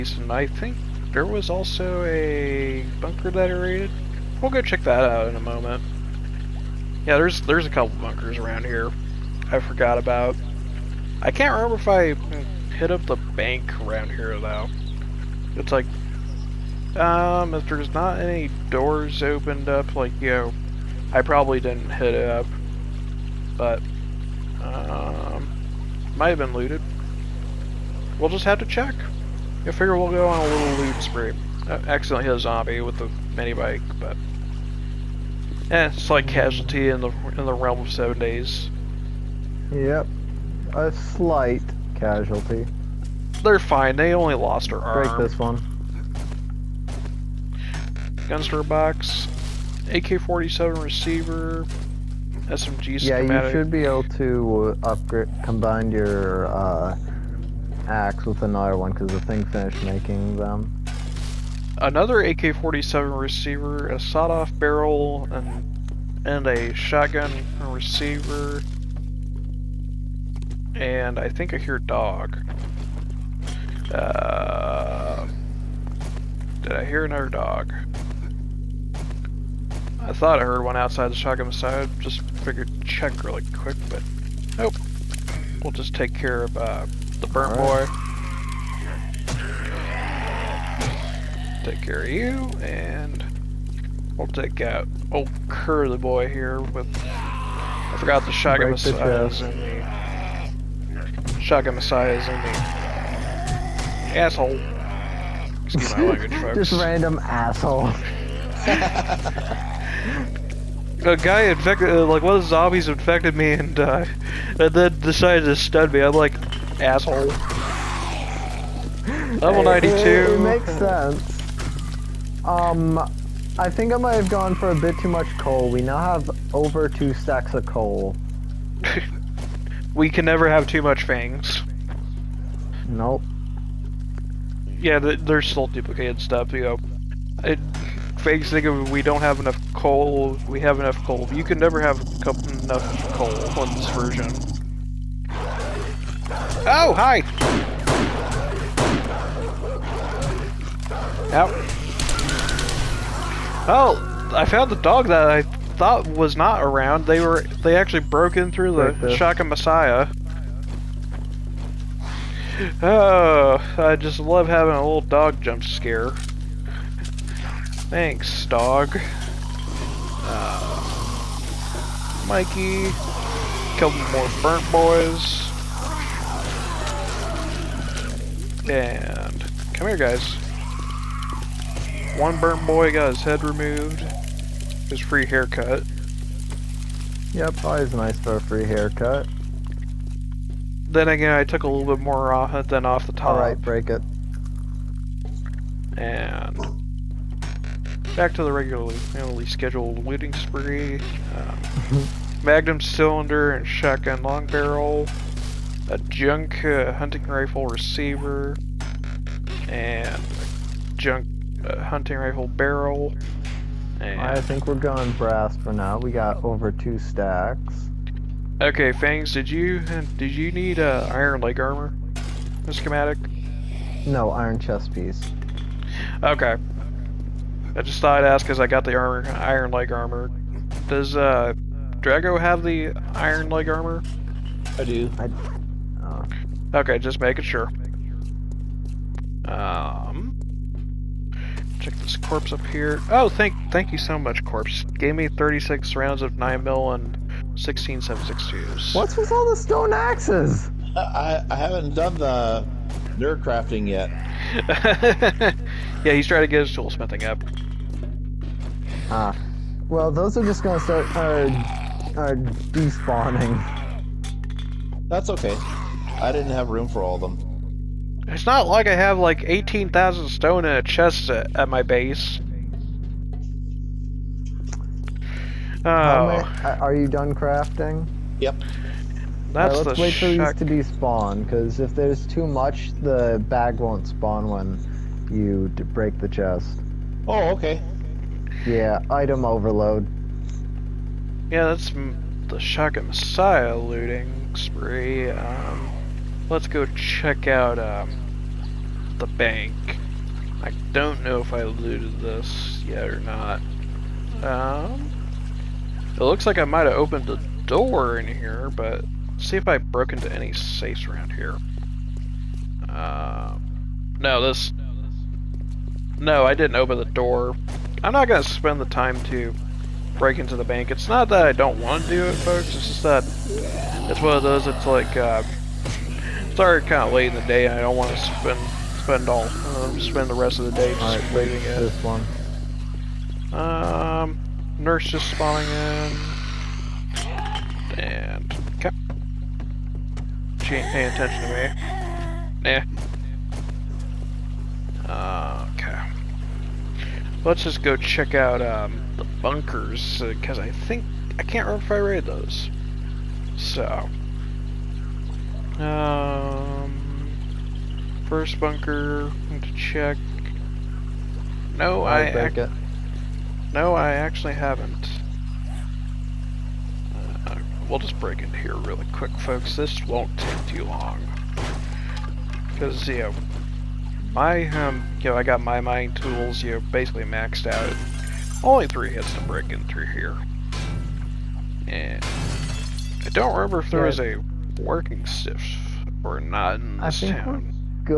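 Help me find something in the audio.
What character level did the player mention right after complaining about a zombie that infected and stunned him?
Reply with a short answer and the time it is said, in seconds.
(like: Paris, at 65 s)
92, at 119 s.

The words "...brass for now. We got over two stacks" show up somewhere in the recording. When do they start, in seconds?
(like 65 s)
215 s.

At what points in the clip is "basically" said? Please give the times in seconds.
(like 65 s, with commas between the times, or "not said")
376 s.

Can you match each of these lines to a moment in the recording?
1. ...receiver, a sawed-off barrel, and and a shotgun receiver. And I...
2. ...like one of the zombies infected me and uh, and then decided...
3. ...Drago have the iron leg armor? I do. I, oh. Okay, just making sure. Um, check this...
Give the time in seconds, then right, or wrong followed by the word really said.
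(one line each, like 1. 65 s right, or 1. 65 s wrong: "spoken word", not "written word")
1. 63 s right
2. 112 s right
3. 232 s right.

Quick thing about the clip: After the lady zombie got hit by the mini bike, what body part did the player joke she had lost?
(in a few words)
her arm.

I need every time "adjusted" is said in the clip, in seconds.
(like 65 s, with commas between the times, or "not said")
not said.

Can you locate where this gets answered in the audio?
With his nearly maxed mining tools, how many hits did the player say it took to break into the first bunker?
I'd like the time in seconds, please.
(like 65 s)
378 s.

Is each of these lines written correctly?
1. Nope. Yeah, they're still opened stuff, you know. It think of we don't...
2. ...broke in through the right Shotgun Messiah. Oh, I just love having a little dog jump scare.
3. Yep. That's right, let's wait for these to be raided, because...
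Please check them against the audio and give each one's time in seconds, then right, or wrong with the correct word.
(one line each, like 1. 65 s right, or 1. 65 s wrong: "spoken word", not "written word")
1. 132 s wrong: "duplicated", not "opened"
2. 158 s right
3. 278 s wrong: "spawned", not "raided".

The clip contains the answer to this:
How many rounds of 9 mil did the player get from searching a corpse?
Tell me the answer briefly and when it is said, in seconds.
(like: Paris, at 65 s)
36, at 245 s.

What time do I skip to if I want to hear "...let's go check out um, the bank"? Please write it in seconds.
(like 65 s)
296 s.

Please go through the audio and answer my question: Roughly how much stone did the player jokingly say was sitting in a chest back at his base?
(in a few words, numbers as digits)
18,000.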